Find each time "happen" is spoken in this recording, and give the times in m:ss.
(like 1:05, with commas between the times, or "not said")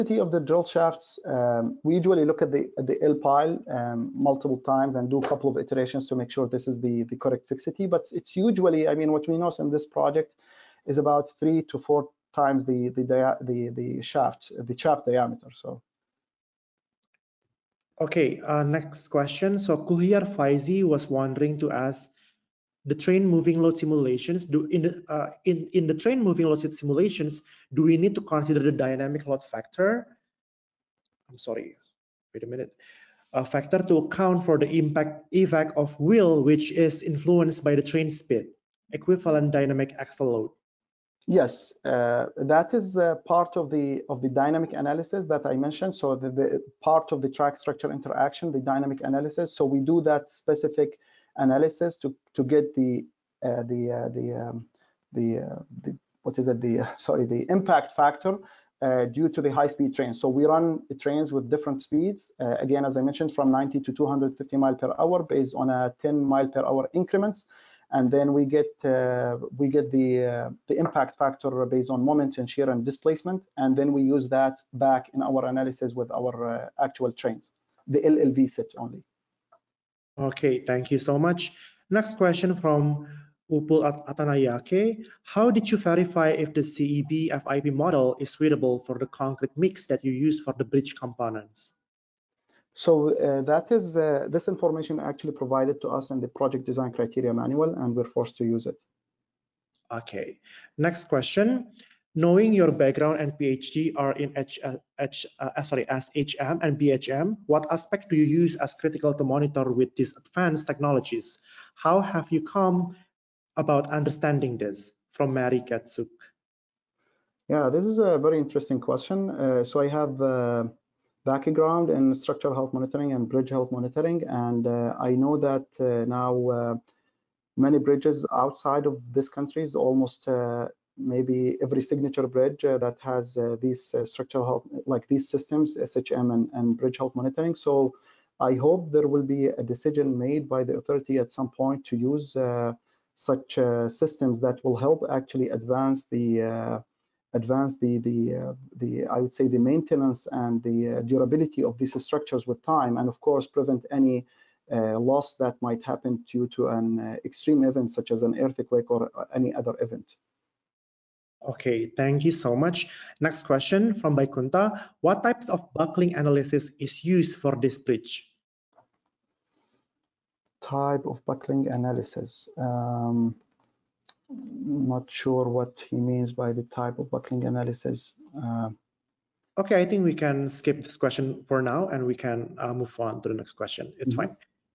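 2:35.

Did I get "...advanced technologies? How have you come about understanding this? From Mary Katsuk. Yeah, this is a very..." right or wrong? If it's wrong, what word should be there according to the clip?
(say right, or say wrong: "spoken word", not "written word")
right.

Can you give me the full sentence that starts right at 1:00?
So we run trains with different speeds.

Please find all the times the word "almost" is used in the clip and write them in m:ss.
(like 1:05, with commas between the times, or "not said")
2:09.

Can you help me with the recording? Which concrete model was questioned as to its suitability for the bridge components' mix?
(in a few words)
CEB FIP.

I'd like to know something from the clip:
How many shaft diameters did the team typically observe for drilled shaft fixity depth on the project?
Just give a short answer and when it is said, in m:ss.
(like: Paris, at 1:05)
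3 to 4, at 0:11.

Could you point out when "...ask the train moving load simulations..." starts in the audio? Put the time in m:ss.
0:21.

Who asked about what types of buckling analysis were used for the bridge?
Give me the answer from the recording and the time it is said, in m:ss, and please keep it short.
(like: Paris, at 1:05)
Baikunta, at 2:44.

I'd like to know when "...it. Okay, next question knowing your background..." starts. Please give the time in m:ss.
1:38.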